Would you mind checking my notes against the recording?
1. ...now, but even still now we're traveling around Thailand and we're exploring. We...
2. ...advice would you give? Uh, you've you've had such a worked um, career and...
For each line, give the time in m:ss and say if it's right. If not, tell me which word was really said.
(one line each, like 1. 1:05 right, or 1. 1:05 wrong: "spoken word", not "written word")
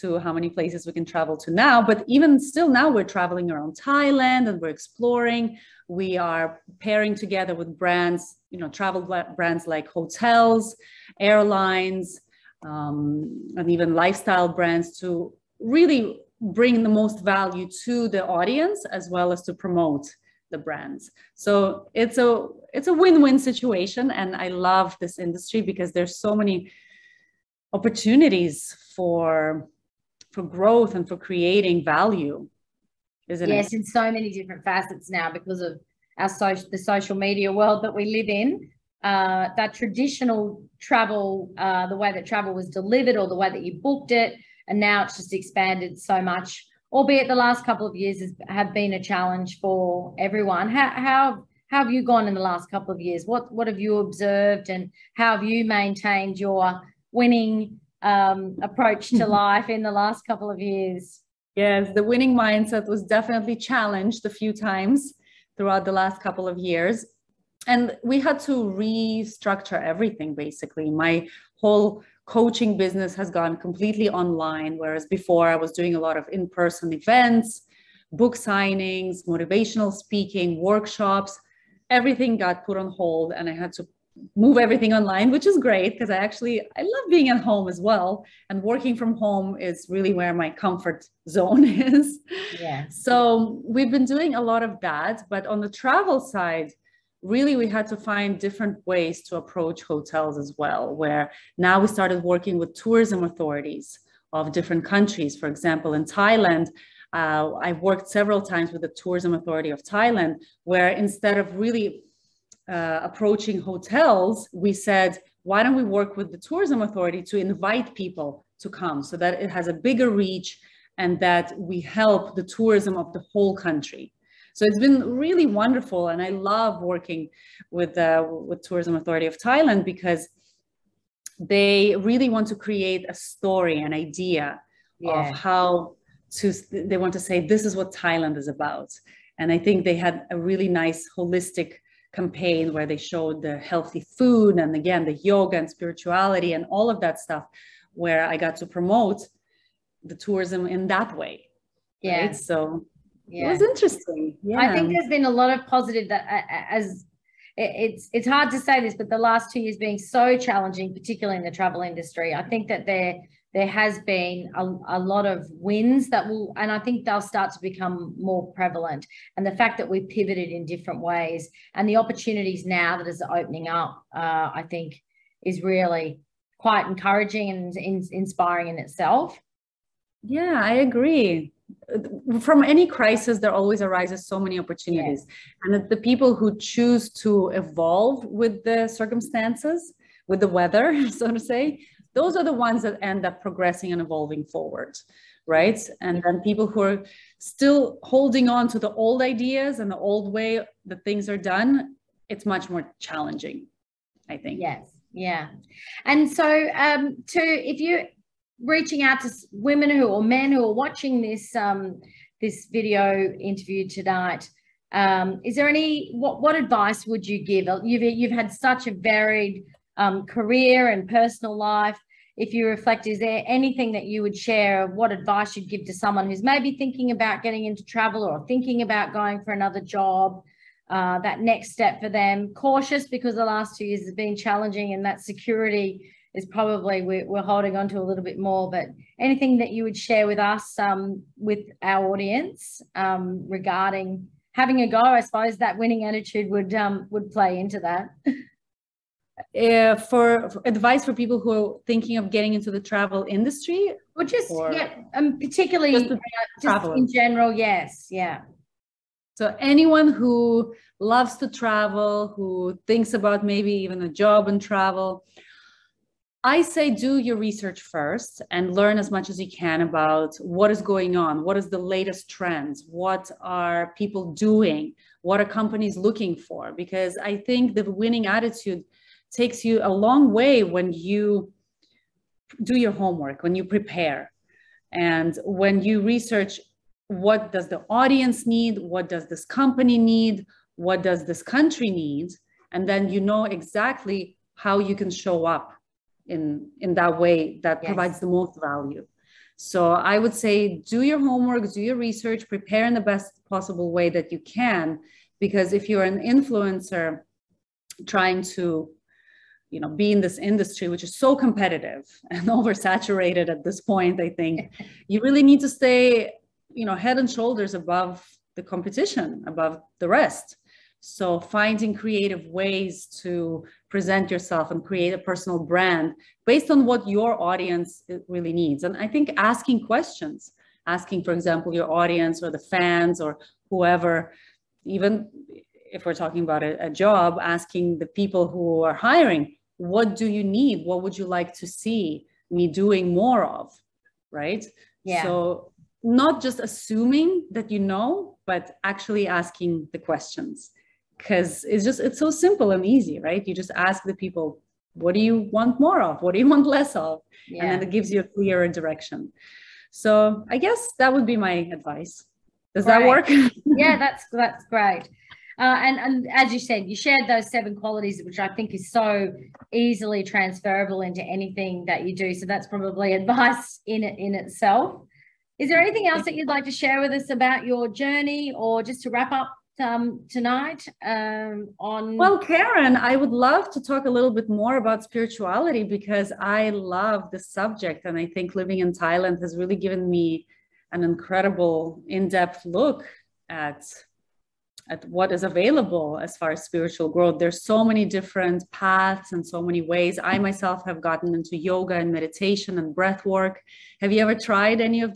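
1. 0:01 right
2. 3:36 wrong: "varied", not "worked".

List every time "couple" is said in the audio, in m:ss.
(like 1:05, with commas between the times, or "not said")
0:47, 0:52, 1:00, 1:06.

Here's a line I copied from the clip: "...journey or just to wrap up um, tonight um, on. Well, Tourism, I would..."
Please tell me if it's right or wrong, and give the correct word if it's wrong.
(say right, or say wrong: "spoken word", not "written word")
wrong: "Karen", not "Tourism".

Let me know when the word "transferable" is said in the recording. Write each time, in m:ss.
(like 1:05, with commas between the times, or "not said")
6:10.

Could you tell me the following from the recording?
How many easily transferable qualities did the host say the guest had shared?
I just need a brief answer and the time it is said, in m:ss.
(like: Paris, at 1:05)
7, at 6:07.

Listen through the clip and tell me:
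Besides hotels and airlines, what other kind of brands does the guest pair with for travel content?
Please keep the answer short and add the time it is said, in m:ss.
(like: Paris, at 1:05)
lifestyle brands, at 0:13.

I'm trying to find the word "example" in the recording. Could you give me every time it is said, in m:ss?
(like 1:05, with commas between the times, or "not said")
1:45, 5:31.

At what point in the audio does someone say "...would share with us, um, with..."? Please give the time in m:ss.
3:59.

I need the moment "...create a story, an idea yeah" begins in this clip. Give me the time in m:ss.
2:12.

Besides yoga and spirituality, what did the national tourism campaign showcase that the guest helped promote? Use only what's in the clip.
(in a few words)
healthy food.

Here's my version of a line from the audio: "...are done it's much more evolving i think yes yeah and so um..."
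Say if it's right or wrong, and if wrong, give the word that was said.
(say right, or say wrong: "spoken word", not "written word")
wrong: "challenging", not "evolving".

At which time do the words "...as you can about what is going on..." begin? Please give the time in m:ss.
4:29.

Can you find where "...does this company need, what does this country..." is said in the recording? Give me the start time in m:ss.
4:49.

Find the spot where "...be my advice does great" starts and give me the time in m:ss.
6:01.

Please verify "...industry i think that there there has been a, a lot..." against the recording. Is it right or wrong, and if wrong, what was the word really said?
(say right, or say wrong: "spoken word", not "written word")
right.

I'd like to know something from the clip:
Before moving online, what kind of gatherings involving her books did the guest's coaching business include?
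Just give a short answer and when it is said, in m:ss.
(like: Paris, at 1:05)
book signings, at 1:18.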